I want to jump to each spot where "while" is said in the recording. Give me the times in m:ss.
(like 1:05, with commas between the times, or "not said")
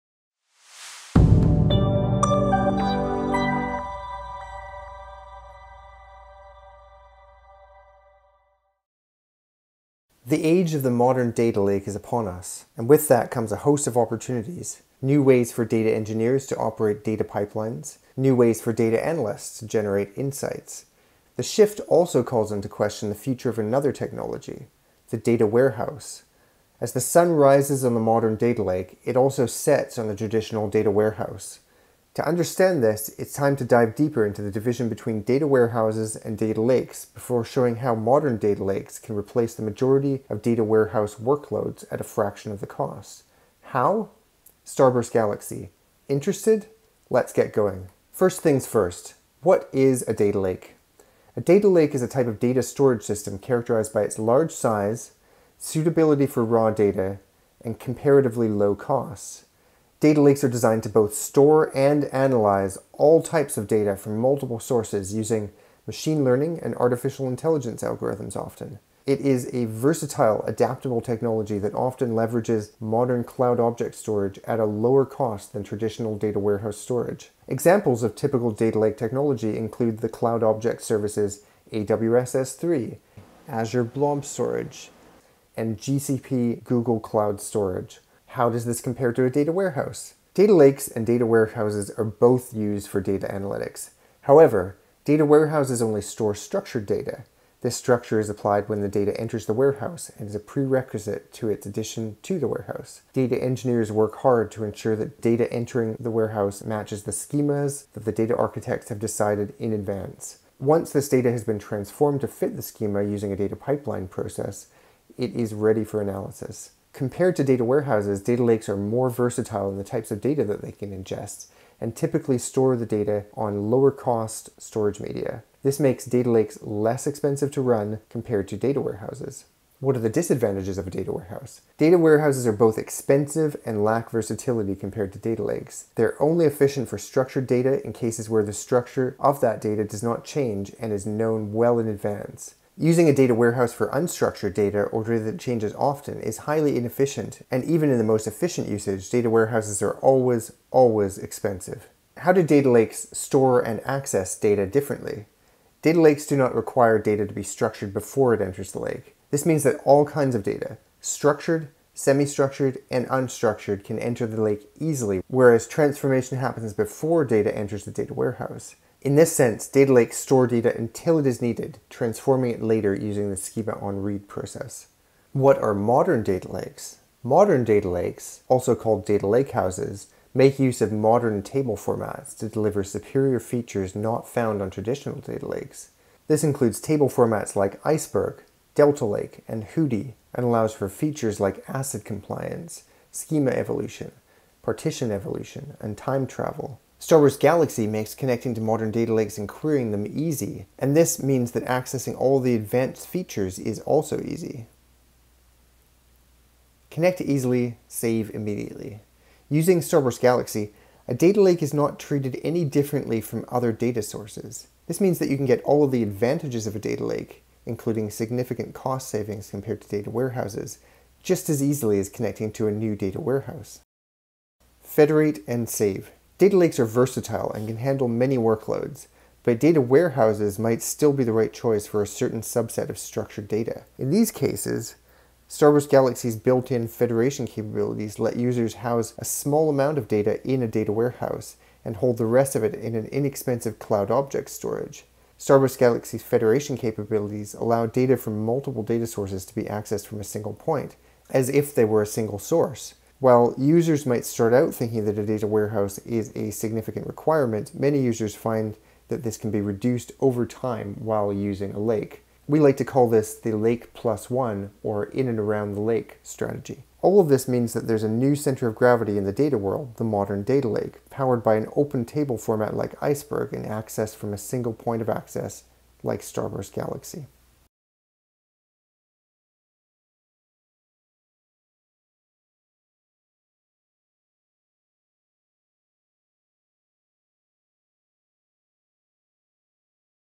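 4:13, 4:20.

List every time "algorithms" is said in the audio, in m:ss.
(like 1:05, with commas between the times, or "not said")
1:07.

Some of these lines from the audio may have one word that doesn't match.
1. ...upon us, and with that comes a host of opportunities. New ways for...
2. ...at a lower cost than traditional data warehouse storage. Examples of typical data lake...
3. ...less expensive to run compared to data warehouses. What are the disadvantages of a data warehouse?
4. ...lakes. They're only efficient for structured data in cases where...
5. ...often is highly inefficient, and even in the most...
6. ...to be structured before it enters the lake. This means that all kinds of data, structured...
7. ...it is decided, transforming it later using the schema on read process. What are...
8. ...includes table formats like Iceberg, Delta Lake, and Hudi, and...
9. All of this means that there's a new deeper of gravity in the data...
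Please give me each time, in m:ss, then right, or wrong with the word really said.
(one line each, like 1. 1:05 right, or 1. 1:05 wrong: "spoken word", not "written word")
1. 0:11 right
2. 1:14 right
3. 2:06 right
4. 2:15 right
5. 2:25 right
6. 2:37 right
7. 2:51 wrong: "needed", not "decided"
8. 3:06 right
9. 4:27 wrong: "center", not "deeper".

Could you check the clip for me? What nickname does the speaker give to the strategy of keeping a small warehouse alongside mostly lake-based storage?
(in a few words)
lake plus one.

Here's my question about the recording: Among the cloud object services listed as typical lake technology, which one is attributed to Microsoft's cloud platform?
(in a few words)
Azure Blob Storage.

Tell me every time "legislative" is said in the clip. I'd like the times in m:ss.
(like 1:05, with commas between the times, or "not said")
not said.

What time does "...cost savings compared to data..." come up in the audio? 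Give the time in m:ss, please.
3:38.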